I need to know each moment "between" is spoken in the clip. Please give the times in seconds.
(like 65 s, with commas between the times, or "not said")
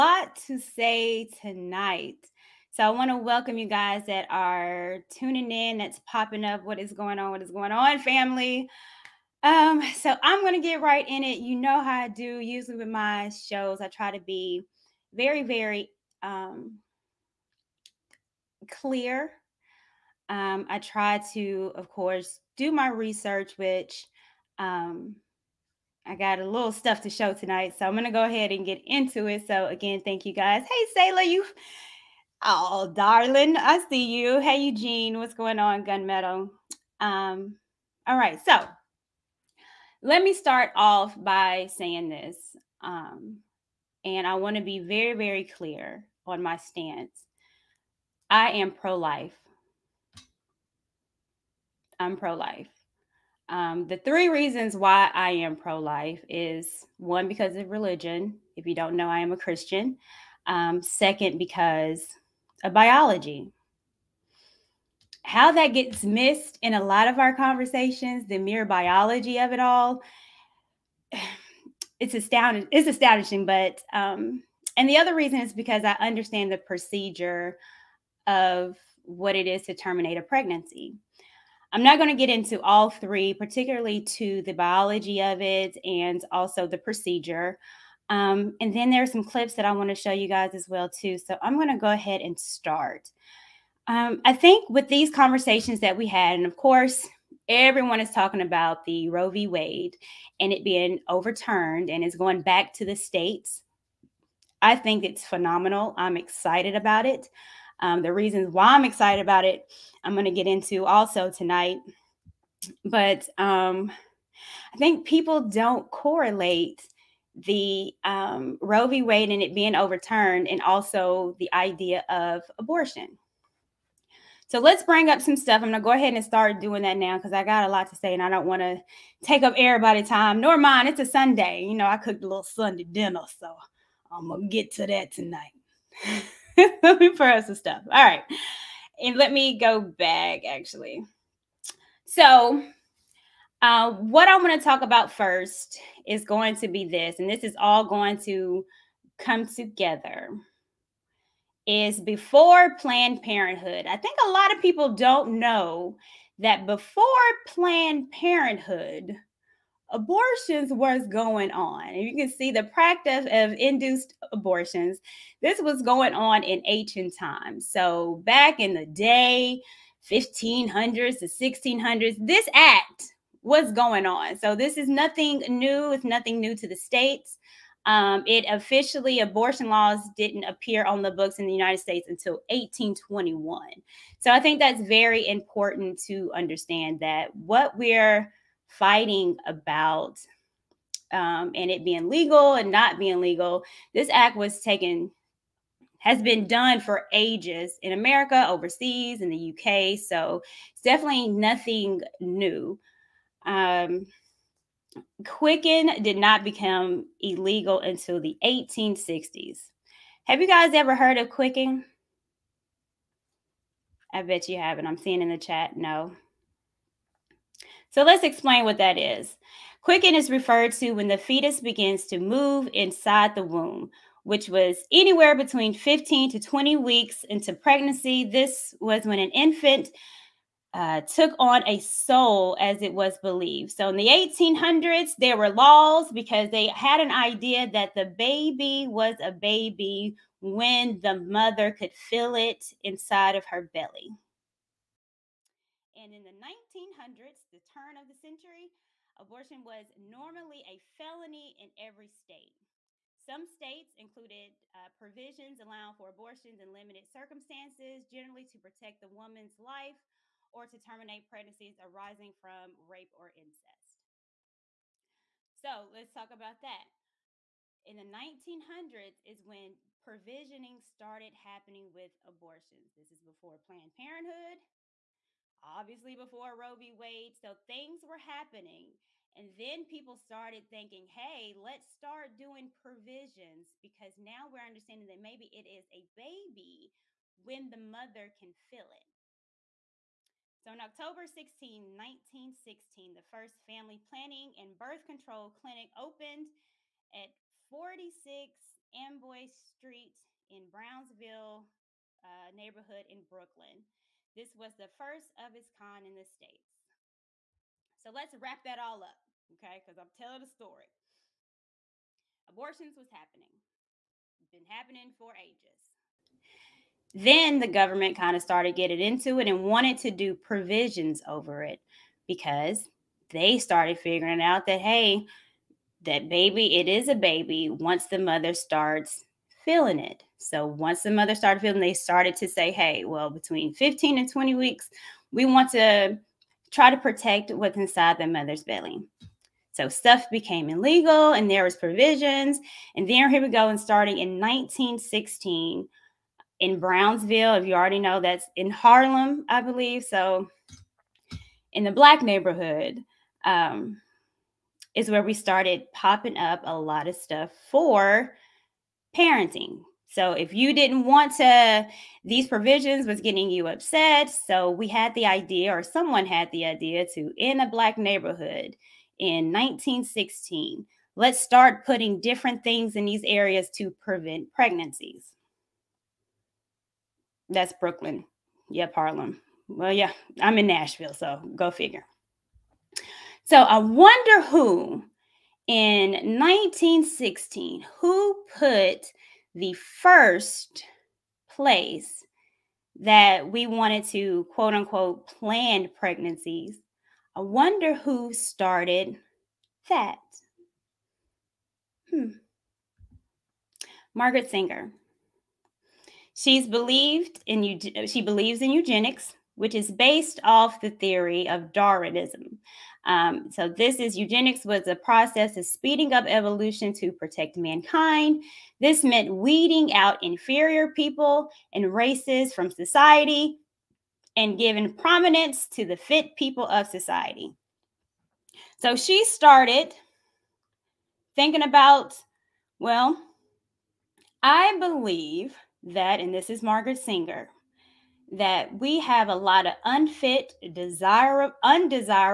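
225 s, 333 s.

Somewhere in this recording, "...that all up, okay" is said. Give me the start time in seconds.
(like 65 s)
308 s.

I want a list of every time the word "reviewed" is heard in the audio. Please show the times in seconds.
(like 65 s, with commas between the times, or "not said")
not said.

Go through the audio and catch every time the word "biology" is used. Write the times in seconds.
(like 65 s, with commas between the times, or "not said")
62 s, 68 s, 84 s.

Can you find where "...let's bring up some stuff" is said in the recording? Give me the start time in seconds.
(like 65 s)
124 s.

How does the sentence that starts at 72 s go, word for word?
It's astonishing, but um, and the other reason is because I understand the procedure of what it is to terminate a pregnancy.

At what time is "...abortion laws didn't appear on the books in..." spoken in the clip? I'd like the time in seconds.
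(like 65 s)
179 s.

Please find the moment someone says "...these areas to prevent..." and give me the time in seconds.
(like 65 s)
373 s.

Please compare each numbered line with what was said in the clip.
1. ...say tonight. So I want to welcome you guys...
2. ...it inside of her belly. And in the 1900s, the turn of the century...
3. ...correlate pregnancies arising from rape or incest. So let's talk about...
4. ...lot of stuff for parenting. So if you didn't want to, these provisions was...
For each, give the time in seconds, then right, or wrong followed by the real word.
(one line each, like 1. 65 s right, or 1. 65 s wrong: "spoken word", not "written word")
1. 0 s right
2. 242 s right
3. 260 s wrong: "terminate", not "correlate"
4. 356 s right.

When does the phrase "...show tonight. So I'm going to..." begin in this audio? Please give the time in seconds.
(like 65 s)
27 s.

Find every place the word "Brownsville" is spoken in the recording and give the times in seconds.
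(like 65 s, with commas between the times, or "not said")
300 s, 346 s.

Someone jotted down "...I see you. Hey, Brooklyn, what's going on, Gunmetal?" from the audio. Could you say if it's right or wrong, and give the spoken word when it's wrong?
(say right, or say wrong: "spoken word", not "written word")
wrong: "Eugene", not "Brooklyn".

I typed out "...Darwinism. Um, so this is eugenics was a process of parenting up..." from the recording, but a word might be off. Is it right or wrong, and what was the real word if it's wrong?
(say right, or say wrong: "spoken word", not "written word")
wrong: "speeding", not "parenting".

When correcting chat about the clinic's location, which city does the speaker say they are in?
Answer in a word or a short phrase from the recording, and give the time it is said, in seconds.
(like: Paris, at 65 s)
Nashville, at 380 s.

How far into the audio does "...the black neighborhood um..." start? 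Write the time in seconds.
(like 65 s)
351 s.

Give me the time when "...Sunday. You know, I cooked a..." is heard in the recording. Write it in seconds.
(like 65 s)
131 s.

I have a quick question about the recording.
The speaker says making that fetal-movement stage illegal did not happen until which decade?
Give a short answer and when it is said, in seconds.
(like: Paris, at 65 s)
1860s, at 208 s.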